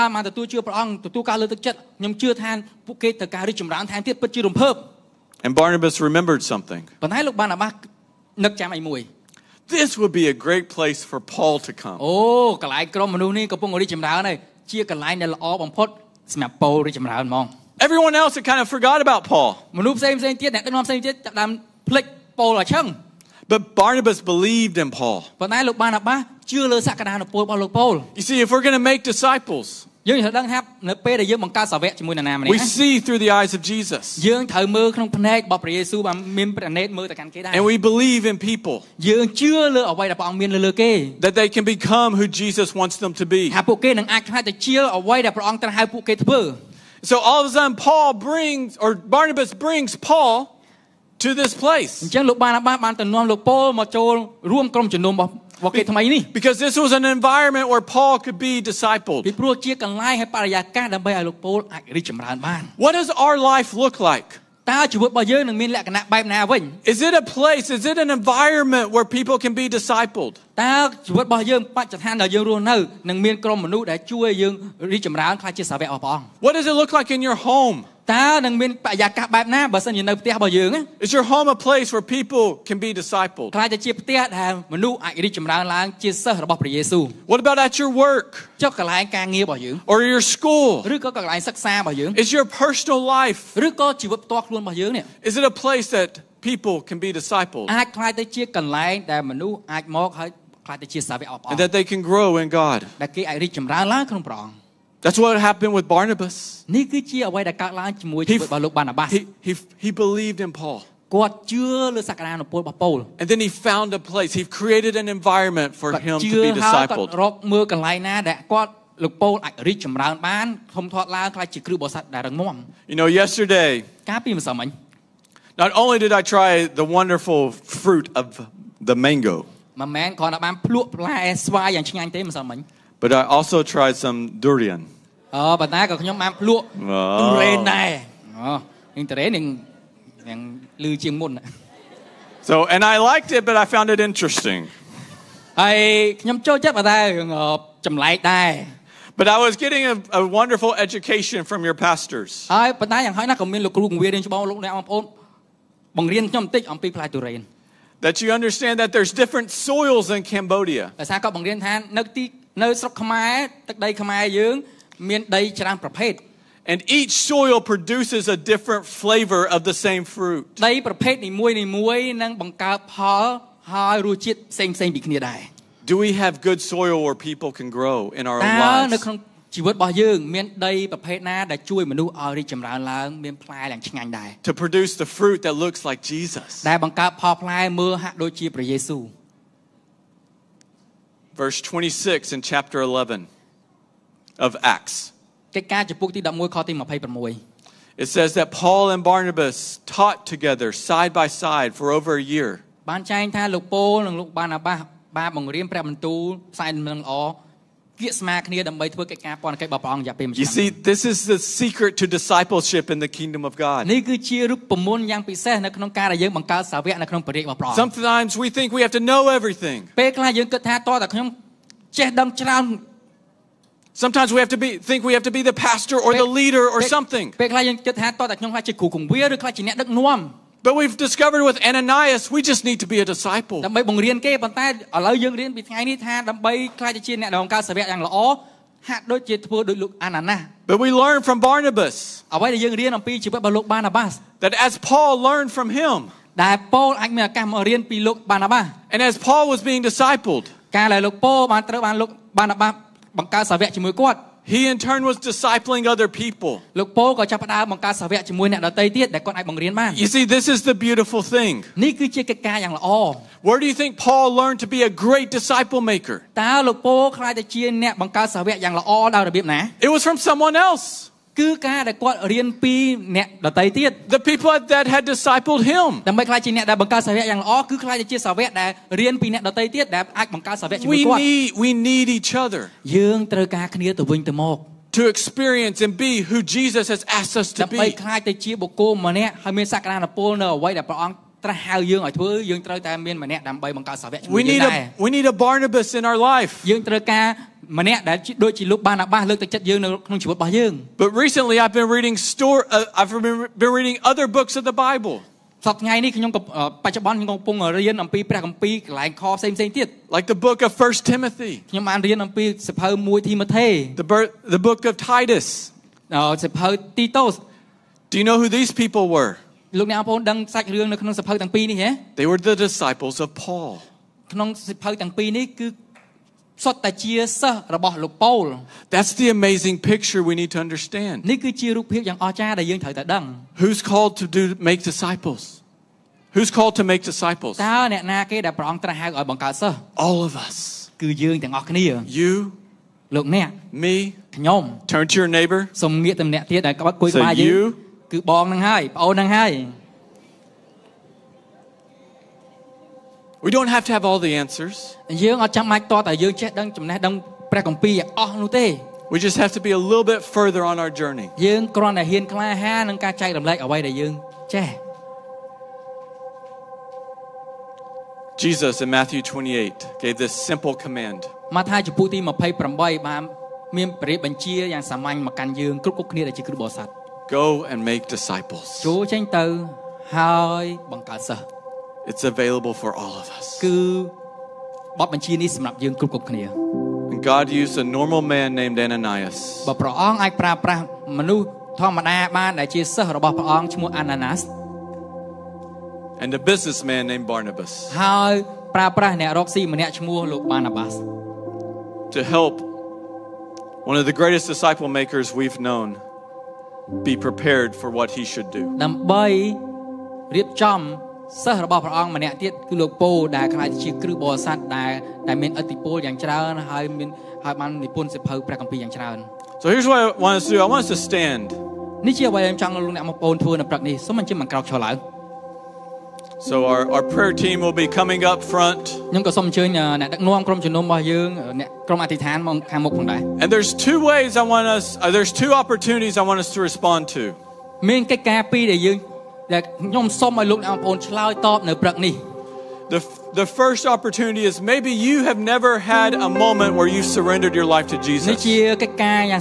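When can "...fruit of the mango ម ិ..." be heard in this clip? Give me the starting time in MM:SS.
02:07.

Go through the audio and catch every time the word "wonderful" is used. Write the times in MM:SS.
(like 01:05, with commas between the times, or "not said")
02:06, 02:30.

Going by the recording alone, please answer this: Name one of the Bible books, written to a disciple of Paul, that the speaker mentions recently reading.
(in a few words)
Titus.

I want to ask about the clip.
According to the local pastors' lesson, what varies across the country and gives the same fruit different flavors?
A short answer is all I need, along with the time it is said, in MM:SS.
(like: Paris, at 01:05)
soils, at 02:38.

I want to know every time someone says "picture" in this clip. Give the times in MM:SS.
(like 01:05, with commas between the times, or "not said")
05:29.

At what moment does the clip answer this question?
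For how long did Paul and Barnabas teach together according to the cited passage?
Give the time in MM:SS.
03:21.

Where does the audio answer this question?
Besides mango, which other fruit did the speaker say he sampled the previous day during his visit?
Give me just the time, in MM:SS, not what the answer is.
02:14.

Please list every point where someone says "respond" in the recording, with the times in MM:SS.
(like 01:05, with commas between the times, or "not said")
07:16.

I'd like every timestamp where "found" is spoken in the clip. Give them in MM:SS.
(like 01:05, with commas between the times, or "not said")
01:53, 02:23.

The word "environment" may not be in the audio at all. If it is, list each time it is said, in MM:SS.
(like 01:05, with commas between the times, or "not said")
00:57, 01:08, 01:55.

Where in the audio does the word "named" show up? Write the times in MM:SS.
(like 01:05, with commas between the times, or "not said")
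06:28, 06:37.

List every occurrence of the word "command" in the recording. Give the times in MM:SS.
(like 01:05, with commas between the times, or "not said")
06:10.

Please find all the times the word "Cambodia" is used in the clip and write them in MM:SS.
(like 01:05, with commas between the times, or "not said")
02:40.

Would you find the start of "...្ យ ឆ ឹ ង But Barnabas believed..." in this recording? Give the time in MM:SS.
00:22.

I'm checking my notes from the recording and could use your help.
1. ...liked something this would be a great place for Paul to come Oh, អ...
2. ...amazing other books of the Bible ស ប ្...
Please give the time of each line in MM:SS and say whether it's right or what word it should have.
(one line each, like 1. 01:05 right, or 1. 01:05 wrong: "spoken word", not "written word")
1. 00:06 wrong: "remembered", not "liked"
2. 05:03 wrong: "reading", not "amazing".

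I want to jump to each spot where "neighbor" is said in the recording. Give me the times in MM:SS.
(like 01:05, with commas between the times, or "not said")
05:45.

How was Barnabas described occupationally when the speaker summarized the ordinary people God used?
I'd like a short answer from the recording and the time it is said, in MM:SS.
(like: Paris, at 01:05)
businessman, at 06:36.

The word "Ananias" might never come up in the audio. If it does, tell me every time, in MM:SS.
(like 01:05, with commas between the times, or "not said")
03:51, 06:28.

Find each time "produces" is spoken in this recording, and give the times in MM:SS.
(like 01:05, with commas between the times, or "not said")
02:47, 03:04.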